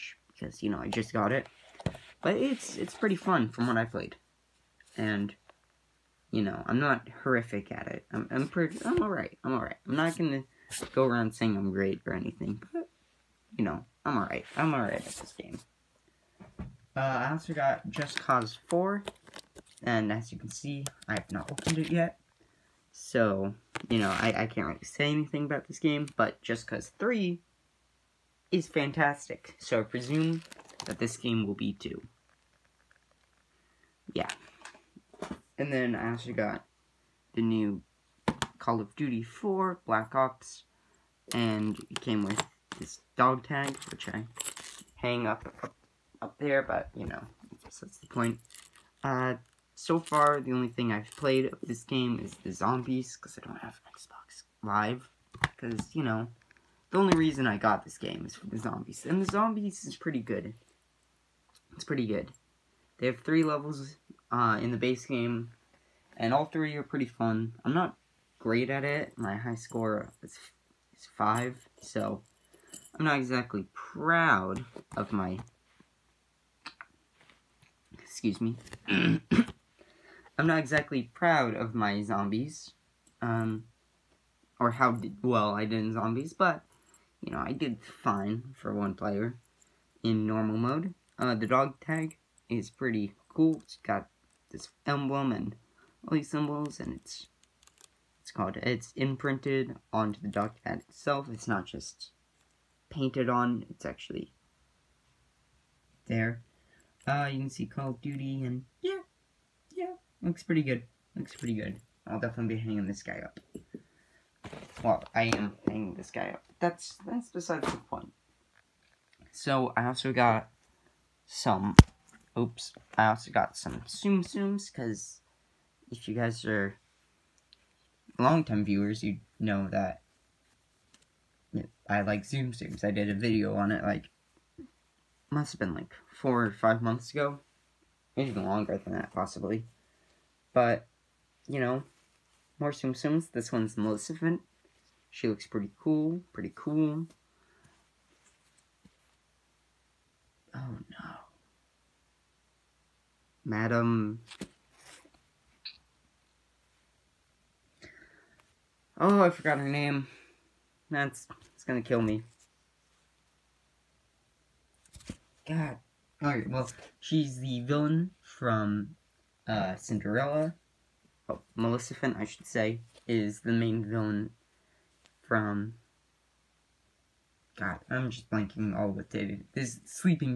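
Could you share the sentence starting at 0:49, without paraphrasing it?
Uh, so far, the only thing I've played of this game is the zombies, because I don't have Xbox Live.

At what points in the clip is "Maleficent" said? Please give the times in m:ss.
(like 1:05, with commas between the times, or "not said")
2:23, 2:51.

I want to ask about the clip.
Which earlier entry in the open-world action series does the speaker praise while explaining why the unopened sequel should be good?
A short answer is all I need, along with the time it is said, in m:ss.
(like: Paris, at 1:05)
Just Cause 3, at 0:26.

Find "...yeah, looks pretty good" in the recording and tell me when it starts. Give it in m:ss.
1:49.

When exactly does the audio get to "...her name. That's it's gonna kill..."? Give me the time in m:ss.
2:39.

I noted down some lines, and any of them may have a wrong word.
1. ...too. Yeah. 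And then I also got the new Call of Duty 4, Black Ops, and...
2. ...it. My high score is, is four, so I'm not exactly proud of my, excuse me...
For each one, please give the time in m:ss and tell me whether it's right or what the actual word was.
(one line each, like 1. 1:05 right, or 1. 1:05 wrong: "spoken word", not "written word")
1. 0:31 right
2. 1:08 wrong: "five", not "four".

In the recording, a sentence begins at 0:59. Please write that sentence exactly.
And the zombies is pretty good.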